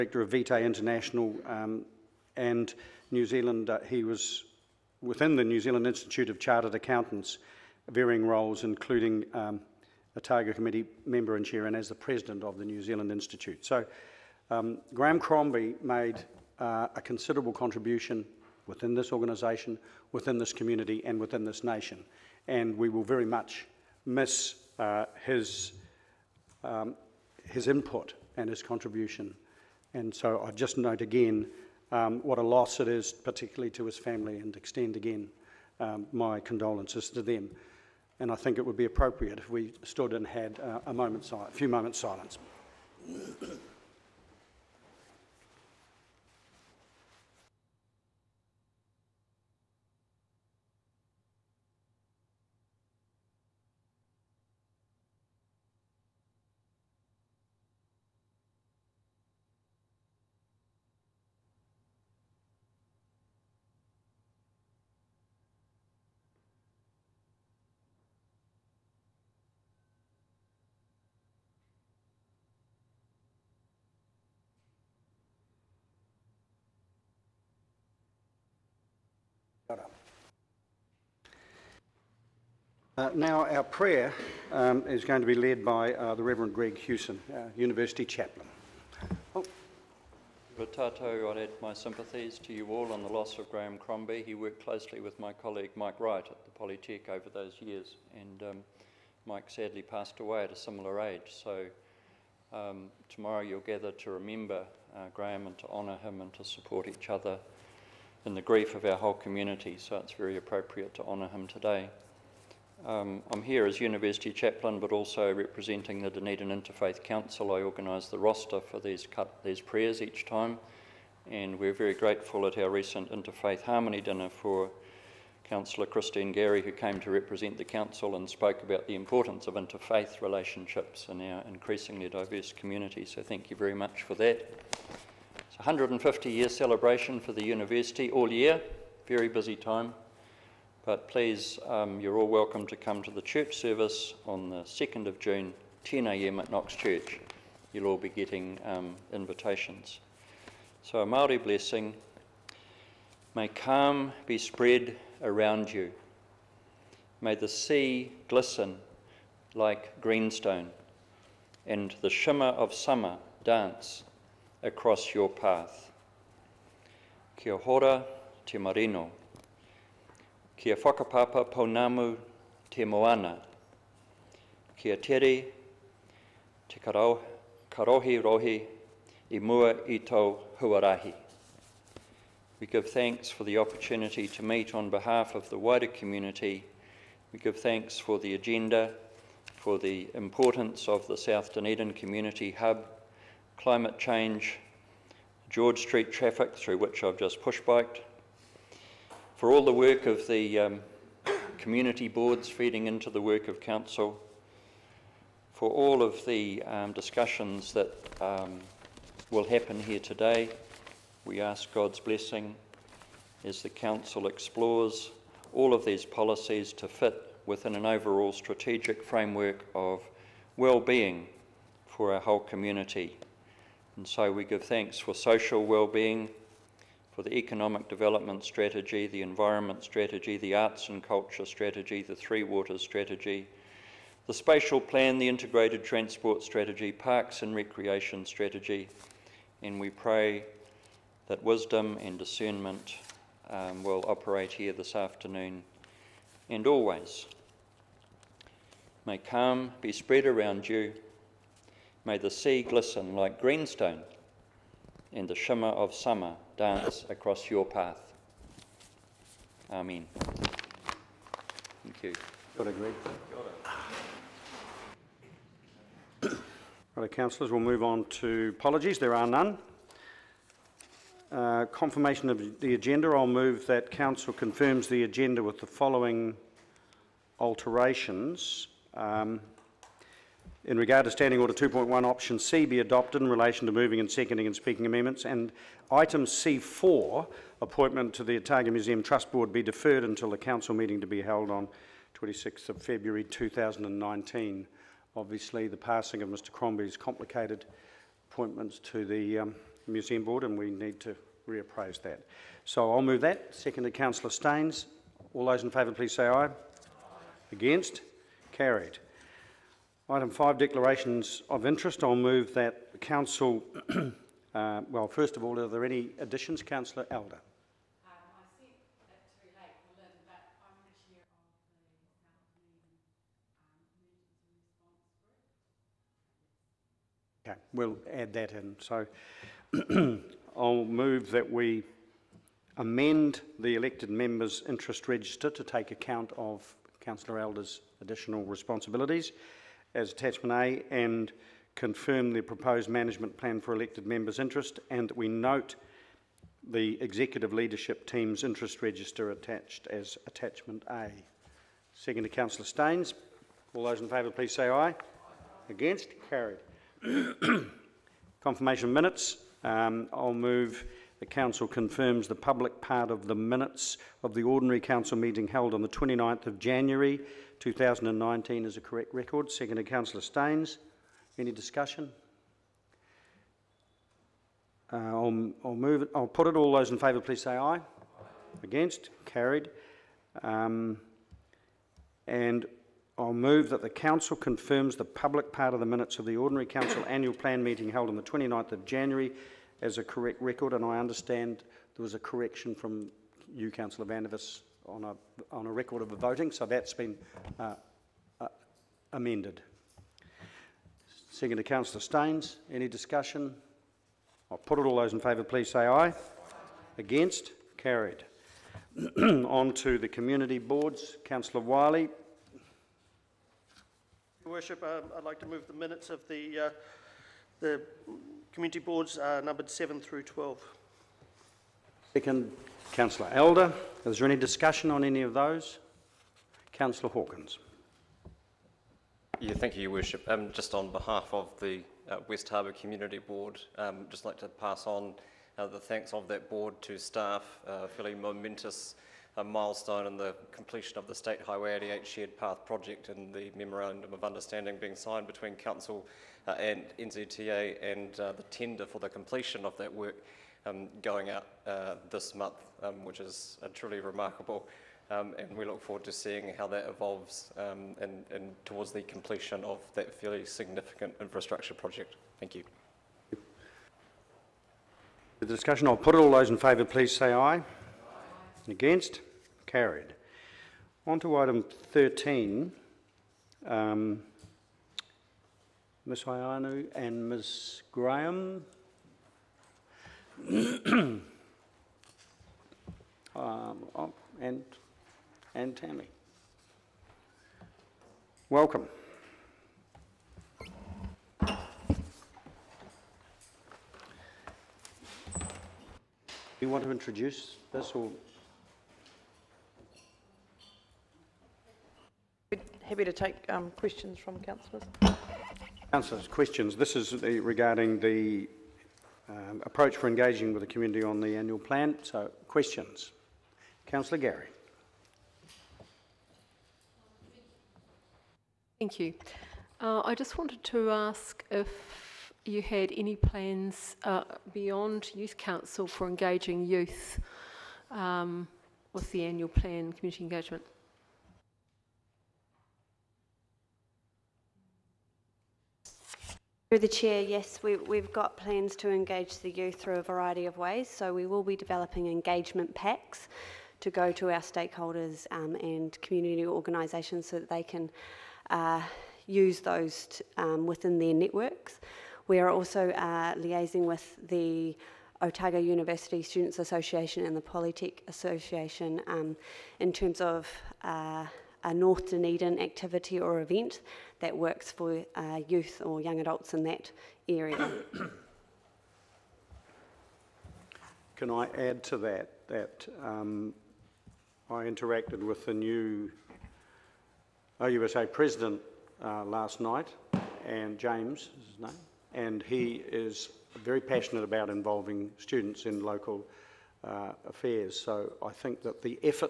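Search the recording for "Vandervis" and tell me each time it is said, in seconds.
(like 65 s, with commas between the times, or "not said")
394 s.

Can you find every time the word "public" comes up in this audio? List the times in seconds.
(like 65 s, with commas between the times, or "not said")
362 s, 385 s.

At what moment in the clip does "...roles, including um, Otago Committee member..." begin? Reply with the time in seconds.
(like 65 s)
8 s.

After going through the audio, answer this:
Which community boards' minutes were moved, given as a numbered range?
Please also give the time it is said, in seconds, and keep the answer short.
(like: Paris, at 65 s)
7 through 12, at 419 s.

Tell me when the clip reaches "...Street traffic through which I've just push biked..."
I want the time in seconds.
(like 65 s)
195 s.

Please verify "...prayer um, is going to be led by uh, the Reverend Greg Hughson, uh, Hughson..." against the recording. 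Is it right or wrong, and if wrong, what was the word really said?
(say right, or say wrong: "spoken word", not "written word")
wrong: "University", not "Hughson".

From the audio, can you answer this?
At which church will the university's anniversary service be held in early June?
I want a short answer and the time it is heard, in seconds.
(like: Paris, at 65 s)
Knox Church, at 146 s.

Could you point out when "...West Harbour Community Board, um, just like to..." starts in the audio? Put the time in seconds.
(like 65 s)
432 s.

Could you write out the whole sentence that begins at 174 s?
Kia tere te karau, karohi rohi i mua i tau huarahi.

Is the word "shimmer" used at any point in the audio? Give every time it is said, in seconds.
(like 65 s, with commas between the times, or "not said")
162 s, 255 s.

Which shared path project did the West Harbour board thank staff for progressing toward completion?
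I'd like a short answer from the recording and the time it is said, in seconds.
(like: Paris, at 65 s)
State Highway 88, at 441 s.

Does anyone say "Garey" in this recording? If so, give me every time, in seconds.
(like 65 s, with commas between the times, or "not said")
126 s, 514 s.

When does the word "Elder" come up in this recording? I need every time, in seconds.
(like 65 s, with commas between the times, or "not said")
317 s, 337 s, 423 s.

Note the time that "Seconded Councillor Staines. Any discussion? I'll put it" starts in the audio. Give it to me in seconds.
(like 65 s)
401 s.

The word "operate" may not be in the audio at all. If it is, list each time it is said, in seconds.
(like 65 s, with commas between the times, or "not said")
244 s.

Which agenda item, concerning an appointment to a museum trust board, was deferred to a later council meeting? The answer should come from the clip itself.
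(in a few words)
Item C4.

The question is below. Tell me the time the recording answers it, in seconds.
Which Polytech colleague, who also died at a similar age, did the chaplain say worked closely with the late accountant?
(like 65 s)
95 s.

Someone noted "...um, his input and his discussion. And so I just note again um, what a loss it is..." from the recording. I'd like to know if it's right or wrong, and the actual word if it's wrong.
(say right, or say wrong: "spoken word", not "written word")
wrong: "contribution", not "discussion".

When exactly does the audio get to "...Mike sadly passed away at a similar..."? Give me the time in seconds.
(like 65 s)
99 s.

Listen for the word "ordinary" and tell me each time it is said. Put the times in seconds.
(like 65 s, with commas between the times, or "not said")
364 s, 386 s.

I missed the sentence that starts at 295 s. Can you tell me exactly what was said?
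Obviously, the passing of Mr Crombie's complicated appointments to the um, Museum Board and we need to reappraise that.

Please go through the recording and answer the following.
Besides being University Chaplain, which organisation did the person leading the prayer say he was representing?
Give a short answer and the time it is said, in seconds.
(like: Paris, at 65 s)
Dunedin Interfaith Council, at 116 s.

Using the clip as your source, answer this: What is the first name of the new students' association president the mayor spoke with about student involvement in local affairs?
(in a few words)
James.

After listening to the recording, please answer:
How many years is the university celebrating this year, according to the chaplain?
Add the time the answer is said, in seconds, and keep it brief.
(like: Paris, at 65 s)
150, at 135 s.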